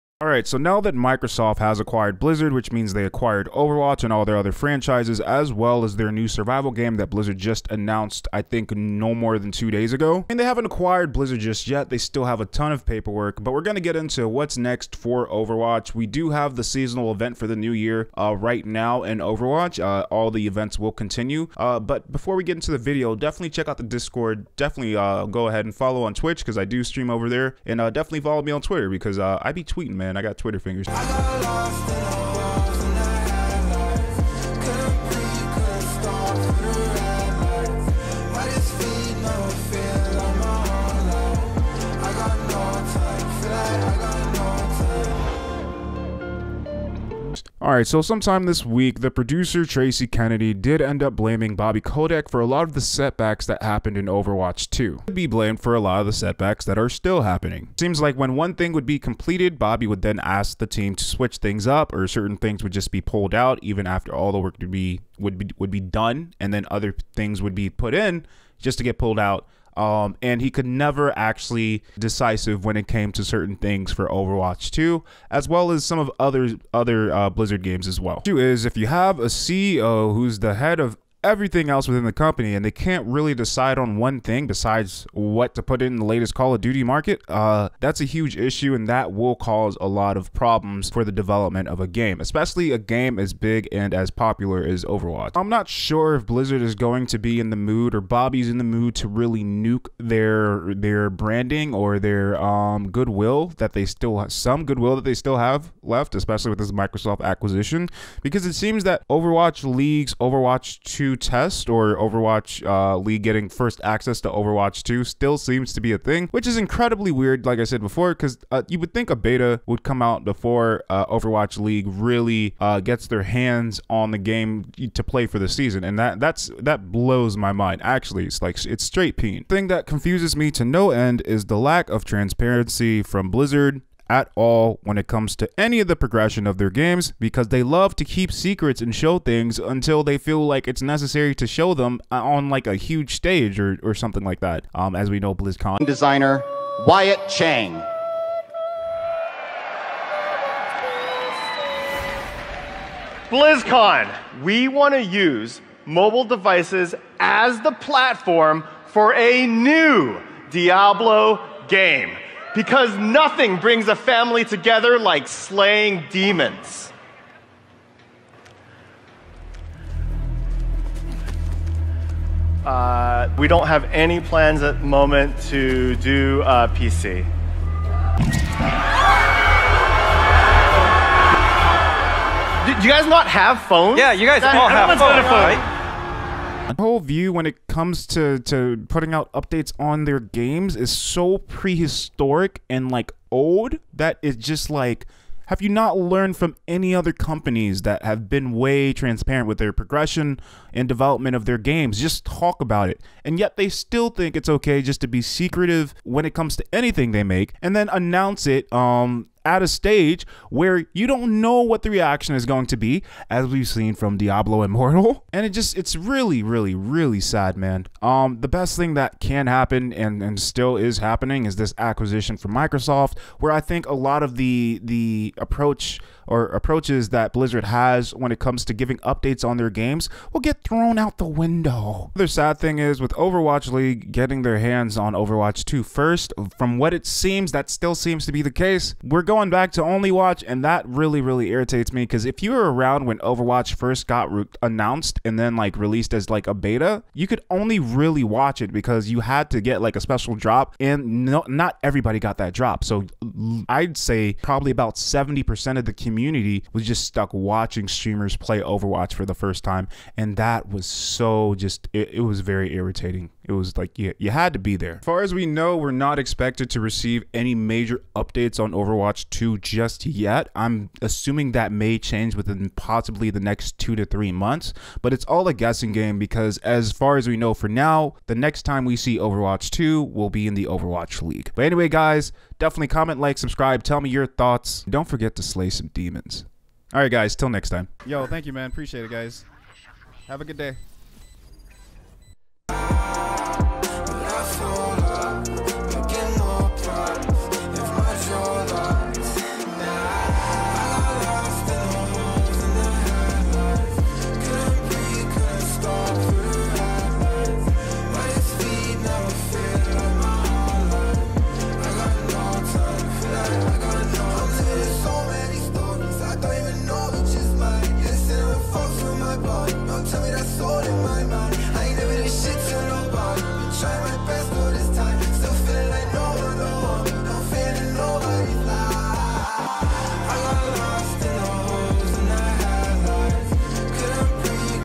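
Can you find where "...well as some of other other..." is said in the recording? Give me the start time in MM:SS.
01:15.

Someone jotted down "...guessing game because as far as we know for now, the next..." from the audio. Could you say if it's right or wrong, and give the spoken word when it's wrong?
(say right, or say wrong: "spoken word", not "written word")
right.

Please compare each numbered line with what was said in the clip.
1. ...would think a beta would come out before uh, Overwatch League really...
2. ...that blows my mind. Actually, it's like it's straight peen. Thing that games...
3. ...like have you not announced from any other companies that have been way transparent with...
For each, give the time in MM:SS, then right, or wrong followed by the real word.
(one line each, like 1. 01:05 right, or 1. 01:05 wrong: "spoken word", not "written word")
1. 01:58 right
2. 02:06 wrong: "confuses", not "games"
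3. 03:14 wrong: "learned", not "announced".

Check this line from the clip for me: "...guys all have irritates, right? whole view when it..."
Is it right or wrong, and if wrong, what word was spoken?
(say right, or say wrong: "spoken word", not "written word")
wrong: "phones", not "irritates".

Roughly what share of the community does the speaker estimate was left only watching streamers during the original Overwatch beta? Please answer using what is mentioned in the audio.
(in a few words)
70%.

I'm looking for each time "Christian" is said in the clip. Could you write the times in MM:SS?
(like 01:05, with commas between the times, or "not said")
not said.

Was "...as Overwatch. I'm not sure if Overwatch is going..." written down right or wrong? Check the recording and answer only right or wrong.
wrong.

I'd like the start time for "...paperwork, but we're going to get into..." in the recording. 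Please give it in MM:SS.
00:12.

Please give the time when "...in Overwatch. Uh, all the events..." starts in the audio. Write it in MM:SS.
00:19.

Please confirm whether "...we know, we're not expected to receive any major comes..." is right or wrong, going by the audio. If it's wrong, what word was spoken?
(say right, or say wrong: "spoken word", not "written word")
wrong: "updates", not "comes".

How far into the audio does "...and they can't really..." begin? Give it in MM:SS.
01:22.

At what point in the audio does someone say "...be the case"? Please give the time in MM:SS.
03:58.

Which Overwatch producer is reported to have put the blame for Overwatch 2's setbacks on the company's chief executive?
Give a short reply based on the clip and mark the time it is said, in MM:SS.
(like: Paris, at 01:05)
Tracy Kennedy, at 00:49.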